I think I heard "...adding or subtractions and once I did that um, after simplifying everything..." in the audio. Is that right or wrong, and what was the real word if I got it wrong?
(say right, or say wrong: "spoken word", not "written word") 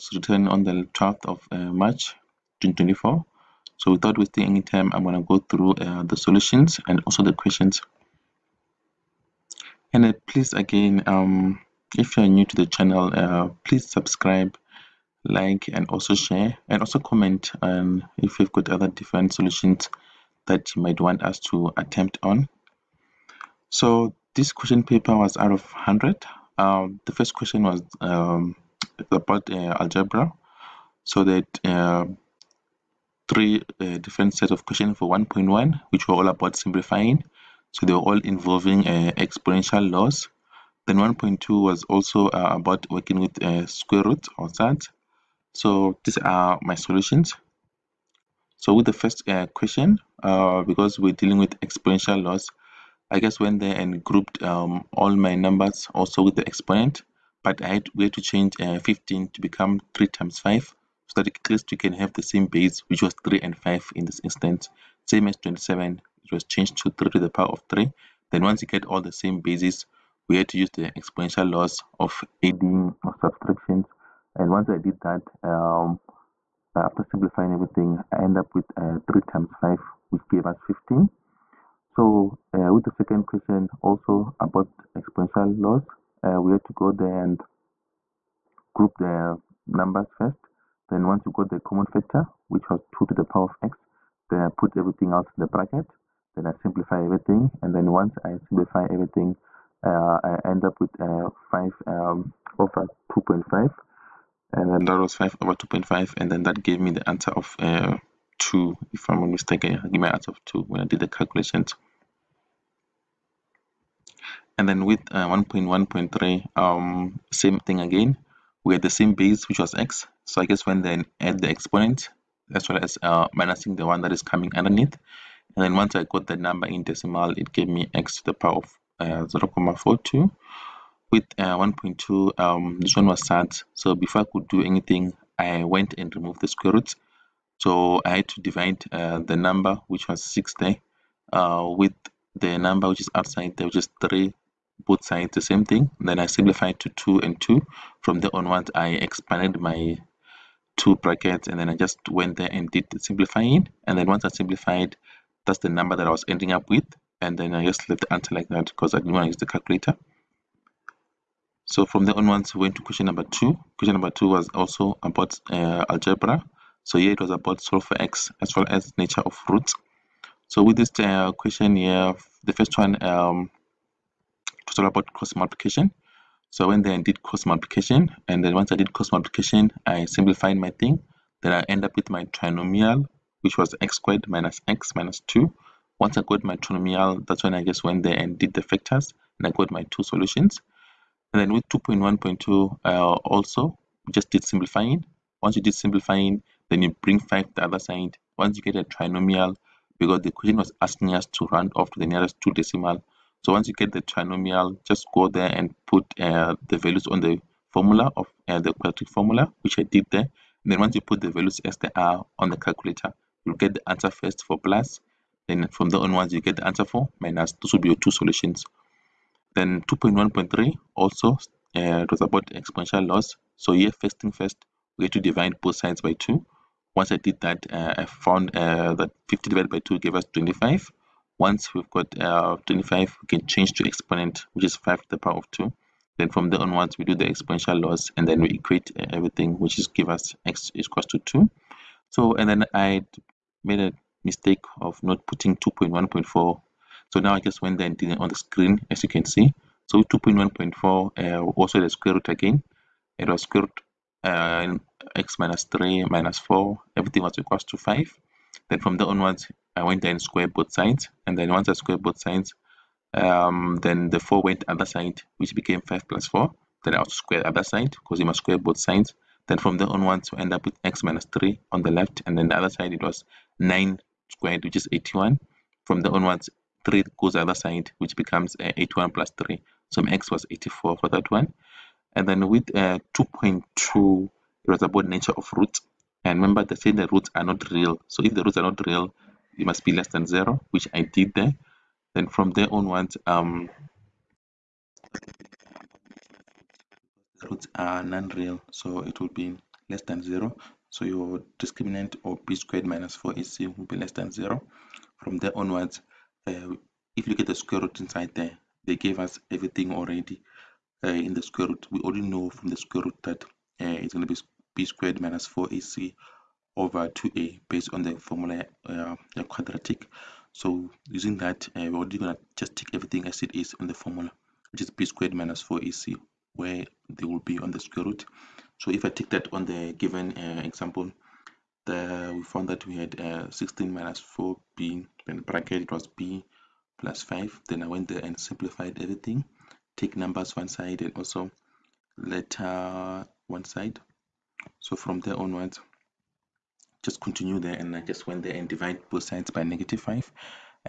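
right.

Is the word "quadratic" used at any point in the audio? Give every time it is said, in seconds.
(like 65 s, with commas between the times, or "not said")
208 s, 319 s.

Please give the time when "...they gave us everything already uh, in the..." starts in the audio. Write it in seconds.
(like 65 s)
308 s.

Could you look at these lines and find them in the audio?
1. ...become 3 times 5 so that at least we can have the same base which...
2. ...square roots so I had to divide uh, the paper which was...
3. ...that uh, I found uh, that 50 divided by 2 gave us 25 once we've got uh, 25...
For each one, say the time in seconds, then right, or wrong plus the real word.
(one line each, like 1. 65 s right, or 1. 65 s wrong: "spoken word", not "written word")
1. 59 s right
2. 136 s wrong: "number", not "paper"
3. 227 s right.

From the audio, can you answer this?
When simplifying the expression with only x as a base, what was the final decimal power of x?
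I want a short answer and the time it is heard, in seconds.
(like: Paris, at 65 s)
0.42, at 129 s.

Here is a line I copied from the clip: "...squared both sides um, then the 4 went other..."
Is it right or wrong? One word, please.
right.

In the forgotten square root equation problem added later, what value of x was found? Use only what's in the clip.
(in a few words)
84.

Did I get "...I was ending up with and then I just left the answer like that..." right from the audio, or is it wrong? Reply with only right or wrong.
right.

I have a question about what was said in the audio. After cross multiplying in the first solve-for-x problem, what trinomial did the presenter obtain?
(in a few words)
x squared minus x minus 2.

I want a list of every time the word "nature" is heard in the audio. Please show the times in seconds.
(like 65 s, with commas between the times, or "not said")
168 s, 285 s.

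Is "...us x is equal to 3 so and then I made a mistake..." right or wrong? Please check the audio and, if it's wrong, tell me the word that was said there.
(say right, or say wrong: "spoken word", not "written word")
wrong: "2", not "3".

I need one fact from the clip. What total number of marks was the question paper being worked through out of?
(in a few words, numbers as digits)
100.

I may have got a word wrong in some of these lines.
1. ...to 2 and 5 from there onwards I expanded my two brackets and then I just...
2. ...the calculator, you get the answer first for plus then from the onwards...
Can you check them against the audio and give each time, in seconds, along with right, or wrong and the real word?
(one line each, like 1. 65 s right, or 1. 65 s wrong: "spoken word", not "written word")
1. 146 s wrong: "2", not "5"
2. 212 s right.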